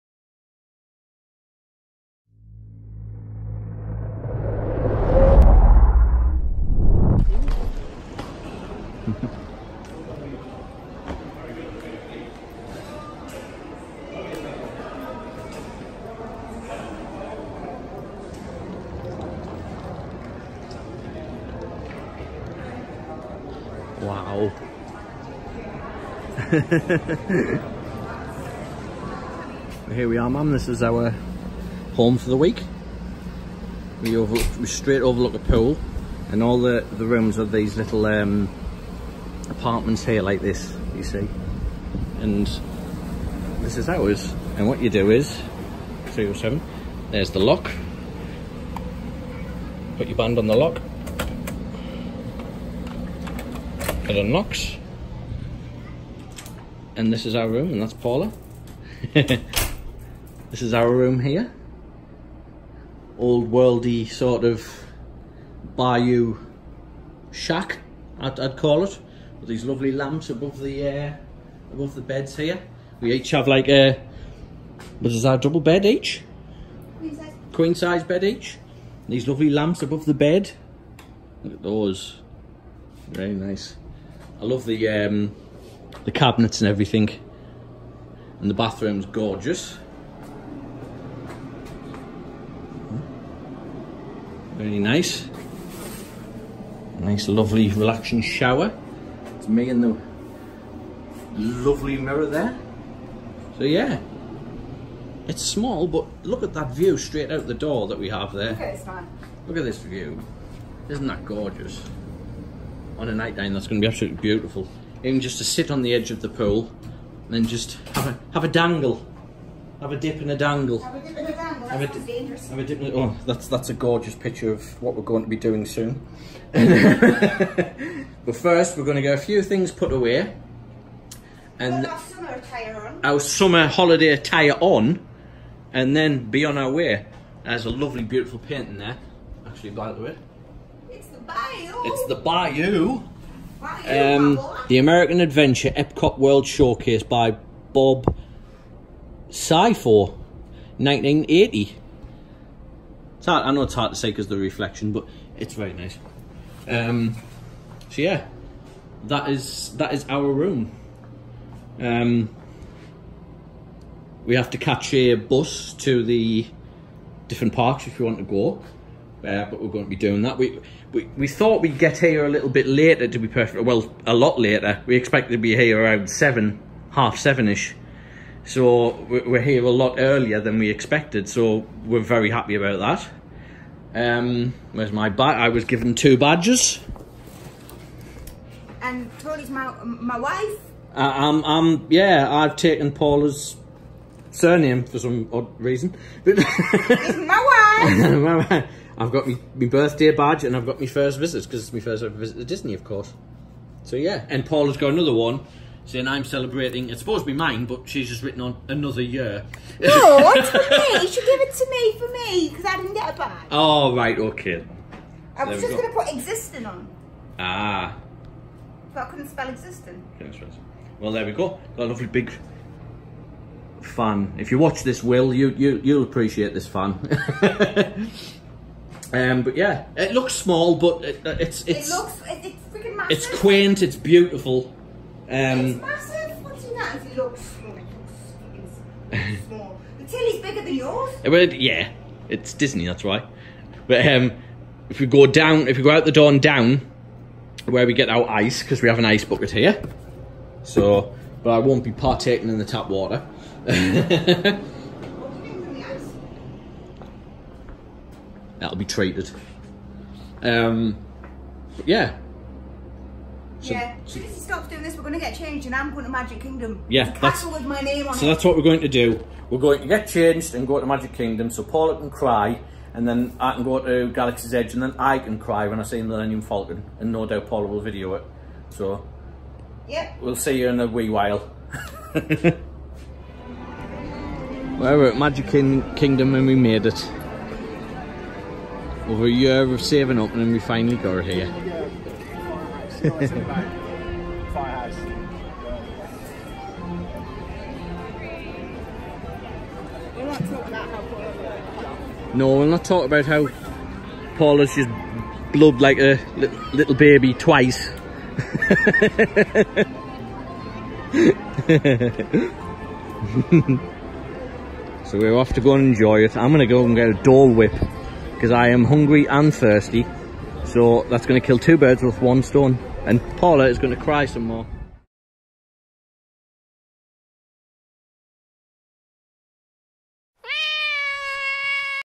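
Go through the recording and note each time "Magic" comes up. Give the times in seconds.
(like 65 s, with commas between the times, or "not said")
266 s, 270 s, 285 s.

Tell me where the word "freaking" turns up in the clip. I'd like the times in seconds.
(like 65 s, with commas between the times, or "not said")
232 s.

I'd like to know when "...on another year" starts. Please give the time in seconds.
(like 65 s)
208 s.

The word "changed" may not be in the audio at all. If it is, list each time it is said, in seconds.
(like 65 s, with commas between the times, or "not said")
265 s, 270 s.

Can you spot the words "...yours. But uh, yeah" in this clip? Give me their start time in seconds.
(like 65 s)
240 s.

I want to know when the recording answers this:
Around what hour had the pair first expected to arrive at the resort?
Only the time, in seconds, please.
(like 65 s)
176 s.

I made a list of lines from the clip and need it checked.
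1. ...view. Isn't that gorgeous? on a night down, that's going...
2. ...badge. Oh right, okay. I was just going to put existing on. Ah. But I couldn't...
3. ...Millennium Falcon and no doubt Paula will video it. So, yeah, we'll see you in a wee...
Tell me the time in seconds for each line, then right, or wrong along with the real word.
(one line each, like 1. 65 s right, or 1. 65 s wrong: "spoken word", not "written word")
1. 109 s right
2. 213 s right
3. 276 s right.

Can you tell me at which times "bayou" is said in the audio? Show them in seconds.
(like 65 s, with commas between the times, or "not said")
65 s, 142 s.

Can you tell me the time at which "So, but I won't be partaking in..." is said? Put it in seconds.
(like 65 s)
250 s.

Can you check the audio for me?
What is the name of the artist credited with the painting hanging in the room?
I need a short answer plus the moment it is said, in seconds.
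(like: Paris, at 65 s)
Bob Seifor, at 147 s.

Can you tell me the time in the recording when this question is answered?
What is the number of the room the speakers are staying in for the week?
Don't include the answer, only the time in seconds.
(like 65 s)
46 s.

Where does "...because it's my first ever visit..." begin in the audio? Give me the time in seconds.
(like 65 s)
201 s.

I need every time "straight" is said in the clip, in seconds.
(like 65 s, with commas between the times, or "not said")
34 s, 106 s.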